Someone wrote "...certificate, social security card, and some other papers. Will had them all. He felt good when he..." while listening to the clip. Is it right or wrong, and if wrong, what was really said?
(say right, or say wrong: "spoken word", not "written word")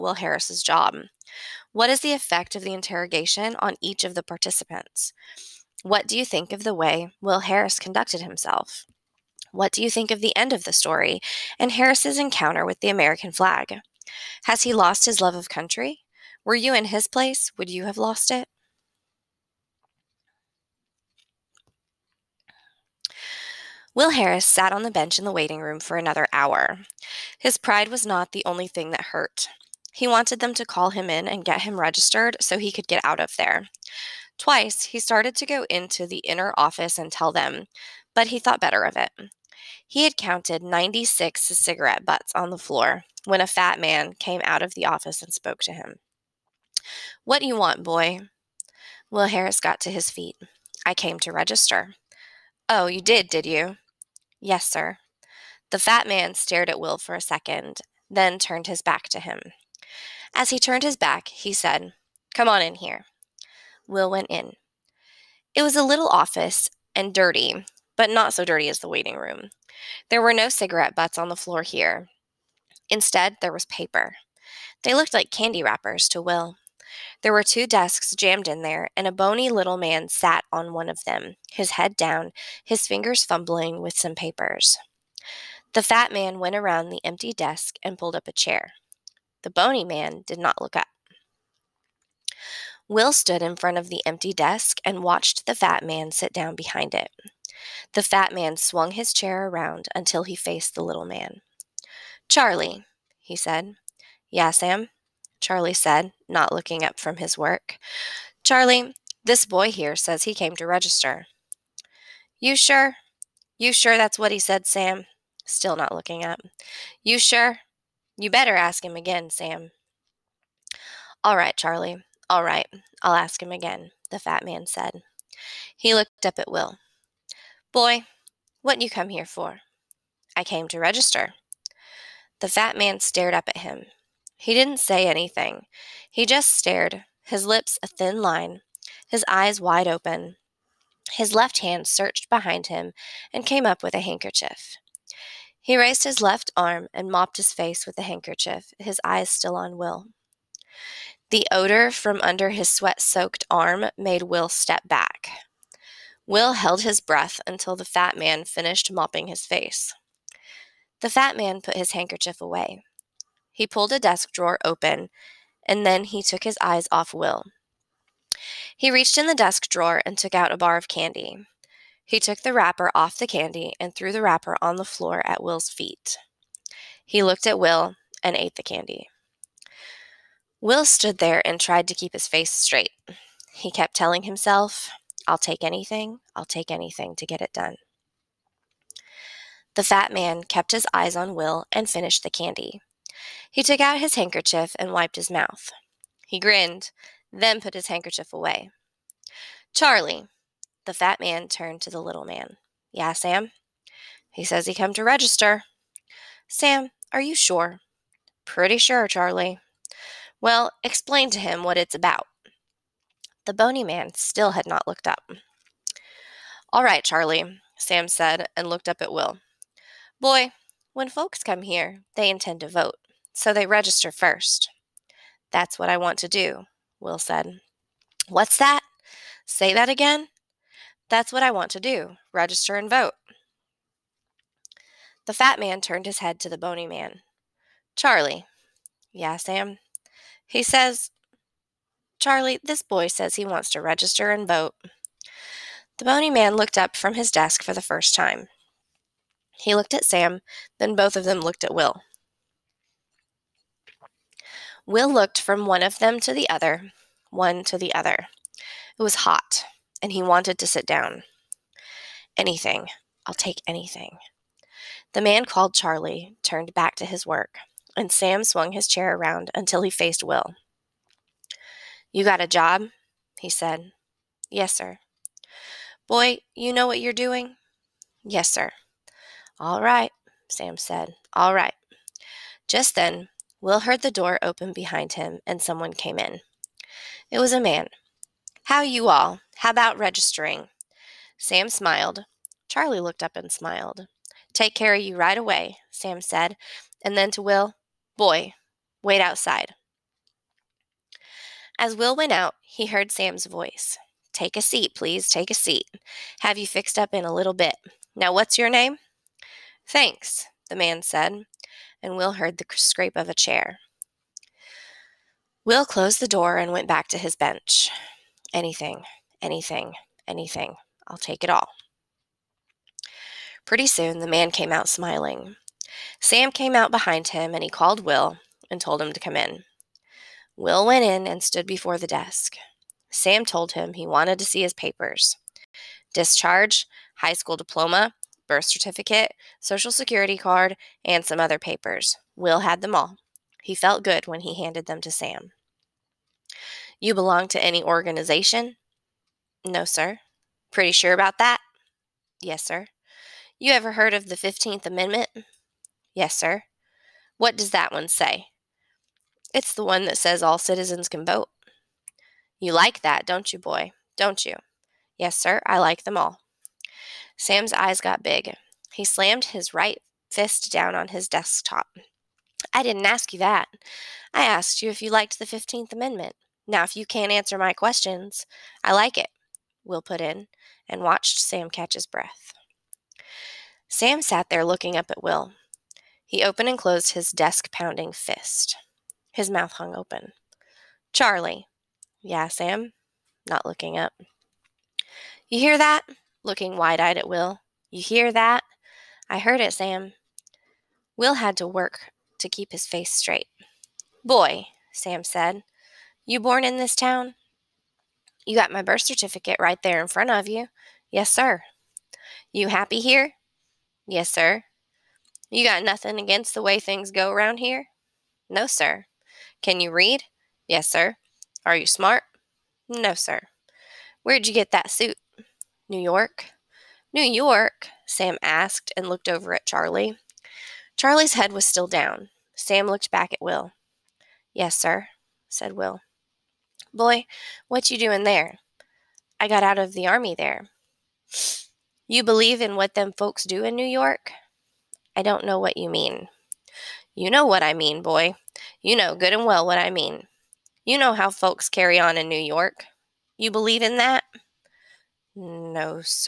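right.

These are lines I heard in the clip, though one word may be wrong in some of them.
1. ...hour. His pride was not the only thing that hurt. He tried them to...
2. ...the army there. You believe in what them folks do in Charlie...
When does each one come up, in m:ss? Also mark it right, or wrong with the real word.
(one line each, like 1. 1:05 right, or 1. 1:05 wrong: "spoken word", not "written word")
1. 0:26 wrong: "wanted", not "tried"
2. 7:19 wrong: "New", not "Charlie".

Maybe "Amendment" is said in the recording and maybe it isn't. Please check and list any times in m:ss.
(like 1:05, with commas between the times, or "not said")
5:54, 6:15.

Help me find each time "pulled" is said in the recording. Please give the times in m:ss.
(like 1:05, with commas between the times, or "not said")
1:27, 2:43.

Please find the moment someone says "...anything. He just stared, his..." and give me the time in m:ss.
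2:15.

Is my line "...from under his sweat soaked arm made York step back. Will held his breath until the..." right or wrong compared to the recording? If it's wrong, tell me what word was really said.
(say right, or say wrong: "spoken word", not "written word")
wrong: "Will", not "York".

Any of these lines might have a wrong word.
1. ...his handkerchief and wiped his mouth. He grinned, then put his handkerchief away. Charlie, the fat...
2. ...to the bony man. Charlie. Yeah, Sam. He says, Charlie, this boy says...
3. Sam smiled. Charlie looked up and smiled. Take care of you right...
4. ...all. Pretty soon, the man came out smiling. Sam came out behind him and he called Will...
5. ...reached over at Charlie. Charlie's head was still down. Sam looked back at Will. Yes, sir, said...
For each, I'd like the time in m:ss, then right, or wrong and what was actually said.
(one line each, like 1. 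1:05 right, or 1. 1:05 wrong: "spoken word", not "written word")
1. 3:13 right
2. 3:56 right
3. 4:51 right
4. 5:21 right
5. 7:09 wrong: "looked", not "reached".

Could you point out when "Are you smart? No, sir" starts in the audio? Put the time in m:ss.
7:01.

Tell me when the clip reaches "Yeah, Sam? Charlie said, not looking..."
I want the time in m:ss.
1:44.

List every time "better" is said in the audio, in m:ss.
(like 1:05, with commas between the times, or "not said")
0:38, 1:58.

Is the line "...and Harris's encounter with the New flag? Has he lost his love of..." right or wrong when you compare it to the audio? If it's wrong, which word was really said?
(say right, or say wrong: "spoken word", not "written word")
wrong: "American", not "New".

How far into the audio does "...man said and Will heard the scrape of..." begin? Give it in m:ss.
5:10.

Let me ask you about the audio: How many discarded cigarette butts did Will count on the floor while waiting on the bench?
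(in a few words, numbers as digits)
96.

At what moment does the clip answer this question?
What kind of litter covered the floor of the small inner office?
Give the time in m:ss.
1:15.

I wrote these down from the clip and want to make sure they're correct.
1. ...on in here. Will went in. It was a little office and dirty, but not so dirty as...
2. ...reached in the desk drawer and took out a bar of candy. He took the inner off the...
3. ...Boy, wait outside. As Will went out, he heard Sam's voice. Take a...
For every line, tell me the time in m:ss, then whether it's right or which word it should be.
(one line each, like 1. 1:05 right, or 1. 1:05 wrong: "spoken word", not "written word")
1. 1:02 right
2. 2:48 wrong: "wrapper", not "inner"
3. 4:58 right.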